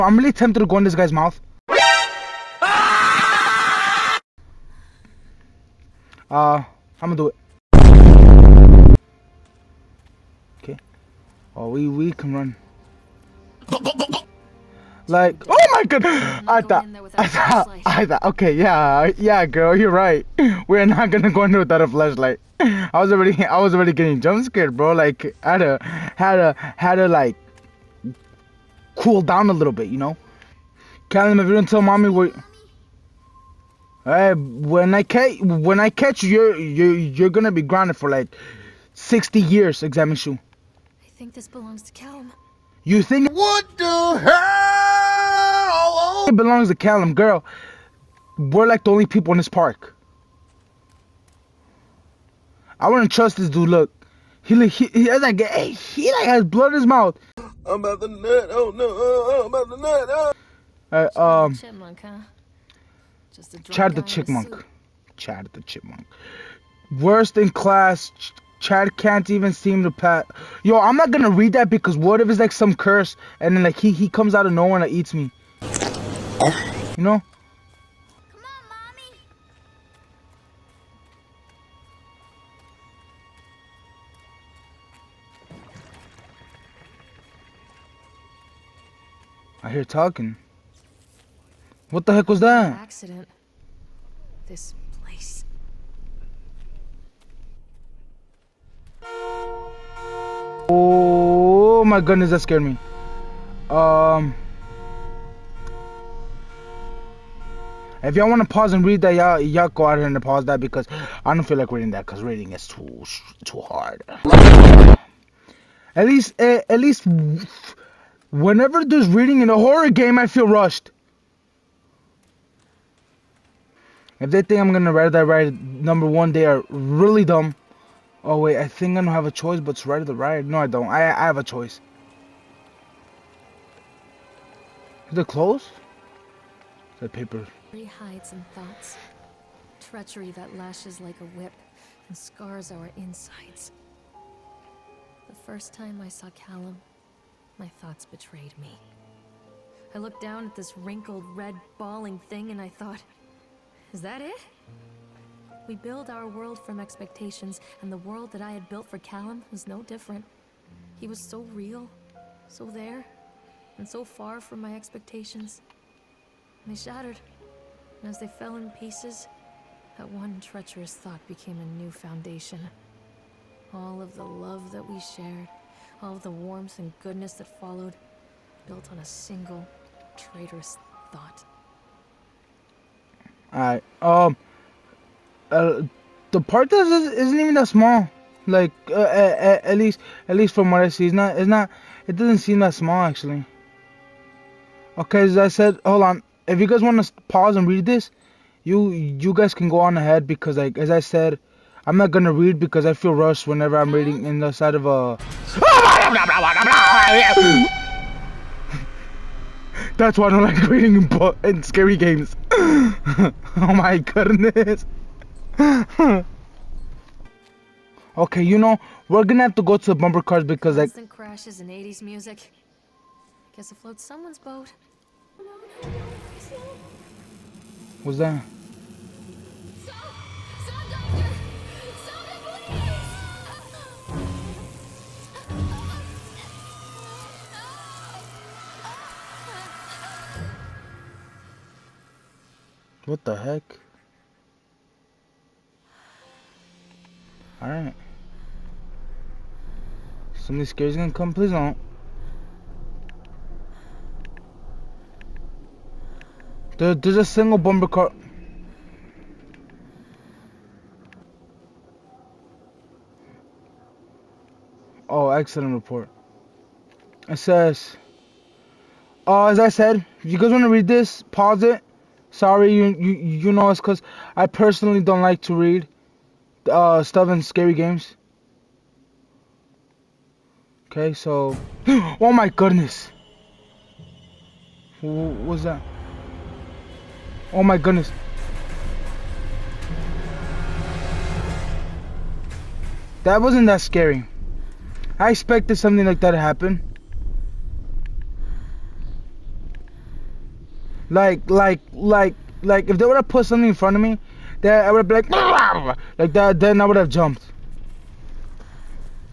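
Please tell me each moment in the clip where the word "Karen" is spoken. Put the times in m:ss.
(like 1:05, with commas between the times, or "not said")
not said.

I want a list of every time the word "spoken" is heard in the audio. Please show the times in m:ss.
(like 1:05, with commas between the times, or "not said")
not said.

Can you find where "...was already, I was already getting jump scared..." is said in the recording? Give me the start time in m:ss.
0:22.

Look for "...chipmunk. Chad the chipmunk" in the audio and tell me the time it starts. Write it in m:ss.
1:04.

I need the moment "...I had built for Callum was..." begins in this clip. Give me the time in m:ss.
2:38.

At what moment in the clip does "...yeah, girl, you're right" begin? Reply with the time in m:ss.
0:19.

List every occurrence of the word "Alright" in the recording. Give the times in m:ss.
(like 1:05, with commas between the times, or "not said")
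3:03, 4:07.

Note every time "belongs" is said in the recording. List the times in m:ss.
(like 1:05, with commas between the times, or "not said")
0:41, 0:46.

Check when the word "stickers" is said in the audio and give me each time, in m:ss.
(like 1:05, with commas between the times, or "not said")
not said.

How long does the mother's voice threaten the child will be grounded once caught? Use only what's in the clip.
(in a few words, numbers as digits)
60 years.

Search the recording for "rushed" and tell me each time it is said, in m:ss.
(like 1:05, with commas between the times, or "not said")
2:00, 3:23.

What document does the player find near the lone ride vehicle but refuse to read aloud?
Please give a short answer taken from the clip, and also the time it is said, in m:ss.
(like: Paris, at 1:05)
Accident report, at 4:25.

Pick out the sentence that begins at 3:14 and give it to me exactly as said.
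Okay, as I said, hold on.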